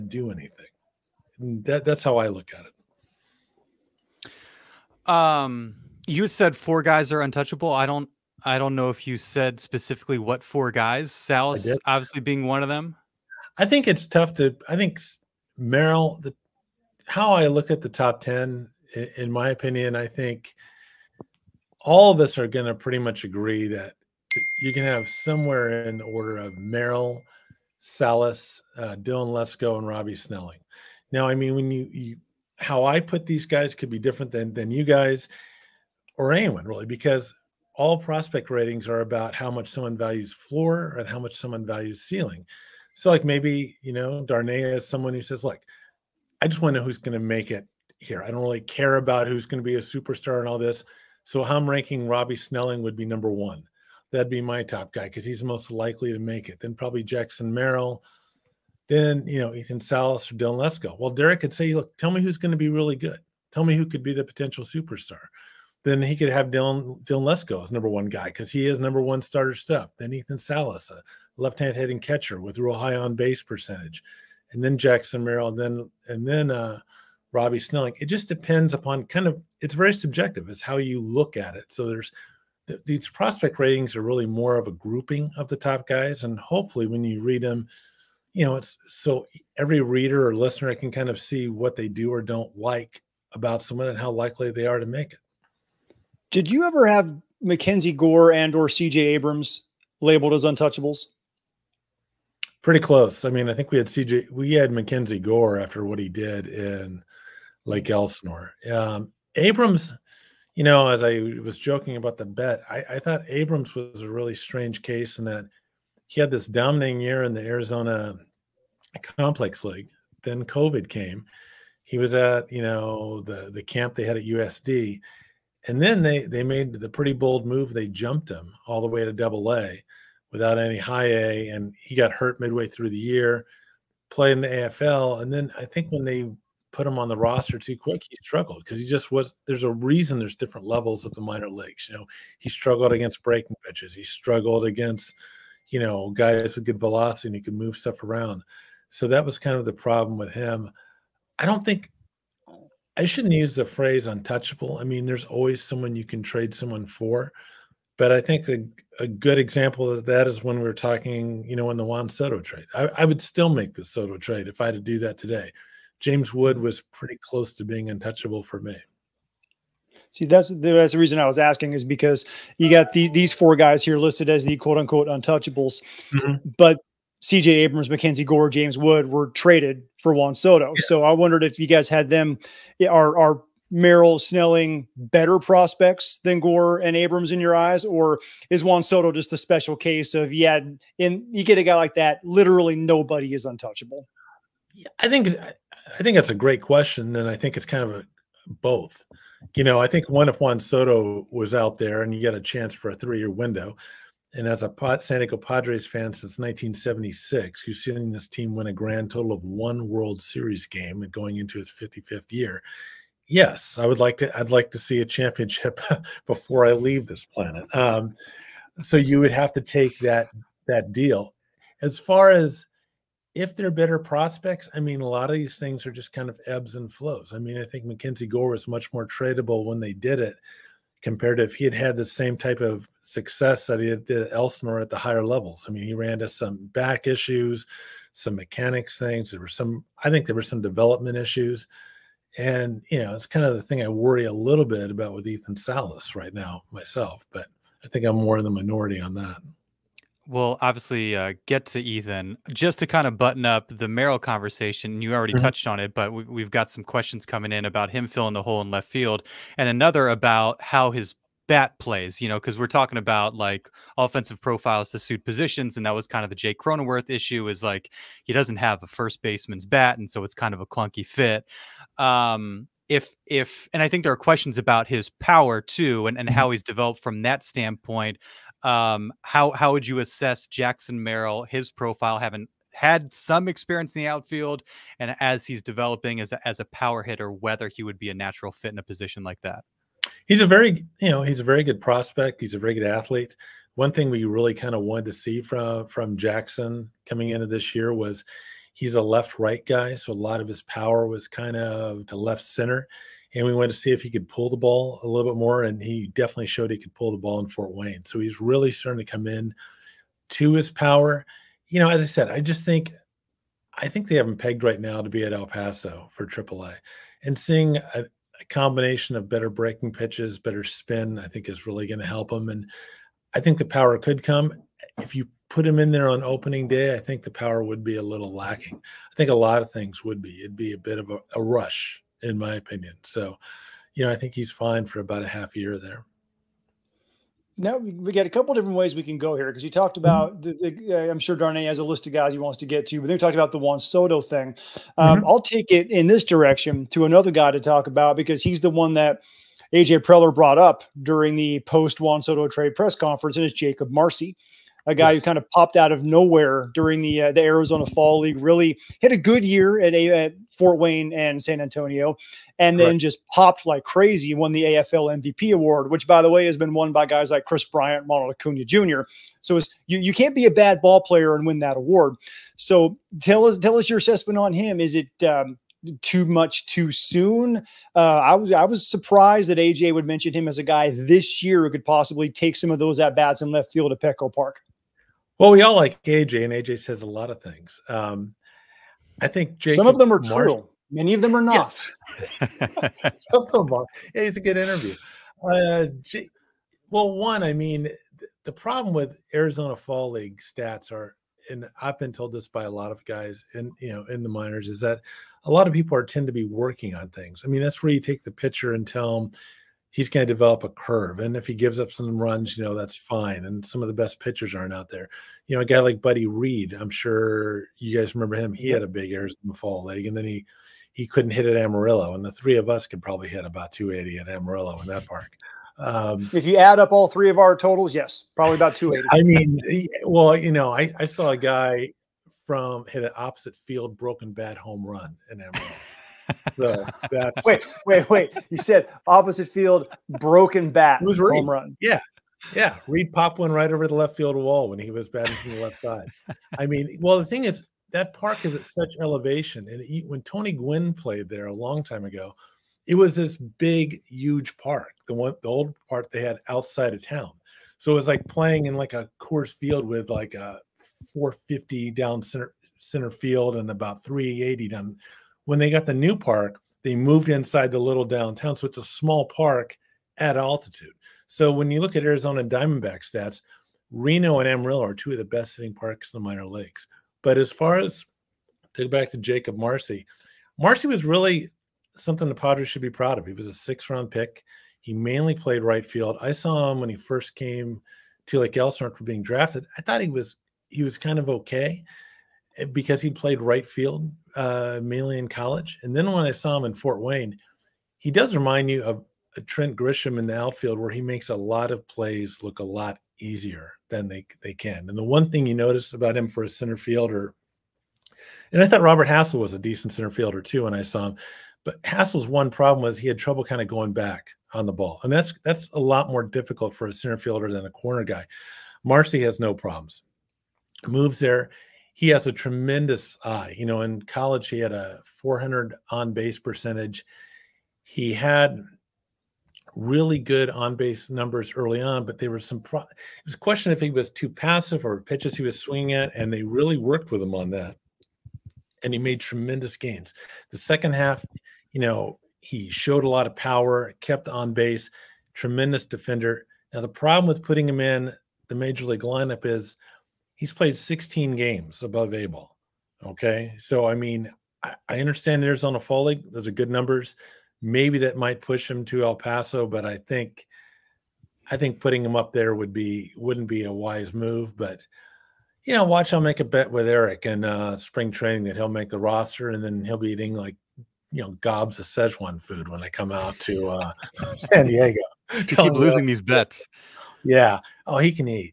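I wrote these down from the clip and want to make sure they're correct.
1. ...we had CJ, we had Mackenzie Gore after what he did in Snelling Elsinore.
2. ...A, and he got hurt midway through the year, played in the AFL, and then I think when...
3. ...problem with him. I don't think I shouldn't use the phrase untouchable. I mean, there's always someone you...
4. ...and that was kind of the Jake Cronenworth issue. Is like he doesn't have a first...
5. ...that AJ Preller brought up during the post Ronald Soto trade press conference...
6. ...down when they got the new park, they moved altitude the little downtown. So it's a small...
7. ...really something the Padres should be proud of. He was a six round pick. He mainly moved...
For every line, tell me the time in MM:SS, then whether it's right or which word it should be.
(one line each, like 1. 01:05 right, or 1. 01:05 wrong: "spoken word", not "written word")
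1. 01:43 wrong: "Lake", not "Snelling"
2. 02:11 right
3. 02:29 right
4. 04:25 right
5. 05:48 wrong: "Juan", not "Ronald"
6. 07:44 wrong: "inside", not "altitude"
7. 08:01 wrong: "played", not "moved".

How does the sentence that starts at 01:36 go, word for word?
Did you ever have Mackenzie Gore and or CJ Abrams labeled as untouchables?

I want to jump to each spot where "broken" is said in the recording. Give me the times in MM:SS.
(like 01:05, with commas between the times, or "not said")
07:13, 07:20.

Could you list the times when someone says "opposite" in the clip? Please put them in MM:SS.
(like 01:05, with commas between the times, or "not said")
07:13, 07:19.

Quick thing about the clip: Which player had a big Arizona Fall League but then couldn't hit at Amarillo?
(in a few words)
Buddy Reed.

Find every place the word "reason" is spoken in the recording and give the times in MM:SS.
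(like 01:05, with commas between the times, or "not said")
02:19, 02:50.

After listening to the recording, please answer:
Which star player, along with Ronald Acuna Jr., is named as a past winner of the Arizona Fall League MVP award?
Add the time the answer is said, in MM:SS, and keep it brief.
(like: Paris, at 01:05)
Kris Bryant, at 06:07.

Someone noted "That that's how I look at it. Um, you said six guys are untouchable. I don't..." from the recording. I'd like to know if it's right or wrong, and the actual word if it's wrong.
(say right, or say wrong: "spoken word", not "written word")
wrong: "four", not "six".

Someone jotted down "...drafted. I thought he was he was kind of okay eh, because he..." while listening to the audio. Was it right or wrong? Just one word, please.
right.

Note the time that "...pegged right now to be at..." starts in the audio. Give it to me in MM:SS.
05:14.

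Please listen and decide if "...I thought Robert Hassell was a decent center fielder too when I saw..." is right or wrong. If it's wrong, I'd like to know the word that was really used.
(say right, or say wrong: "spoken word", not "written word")
right.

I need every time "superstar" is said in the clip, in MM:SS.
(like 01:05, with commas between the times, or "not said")
00:49, 01:04.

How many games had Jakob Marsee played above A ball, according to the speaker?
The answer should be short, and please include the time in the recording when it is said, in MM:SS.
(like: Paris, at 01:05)
16, at 09:10.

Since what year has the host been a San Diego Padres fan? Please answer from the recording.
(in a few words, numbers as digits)
1976.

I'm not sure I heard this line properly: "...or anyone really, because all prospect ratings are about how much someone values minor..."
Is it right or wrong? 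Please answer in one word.
wrong.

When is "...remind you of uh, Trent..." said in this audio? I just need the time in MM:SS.
08:18.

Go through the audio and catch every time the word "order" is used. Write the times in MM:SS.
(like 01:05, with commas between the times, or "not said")
00:26.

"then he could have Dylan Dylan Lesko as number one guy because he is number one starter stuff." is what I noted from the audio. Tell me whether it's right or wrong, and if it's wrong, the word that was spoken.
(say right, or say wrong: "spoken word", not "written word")
right.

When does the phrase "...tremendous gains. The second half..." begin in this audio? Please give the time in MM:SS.
08:59.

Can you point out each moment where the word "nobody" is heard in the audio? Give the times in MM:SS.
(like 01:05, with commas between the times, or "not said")
03:12.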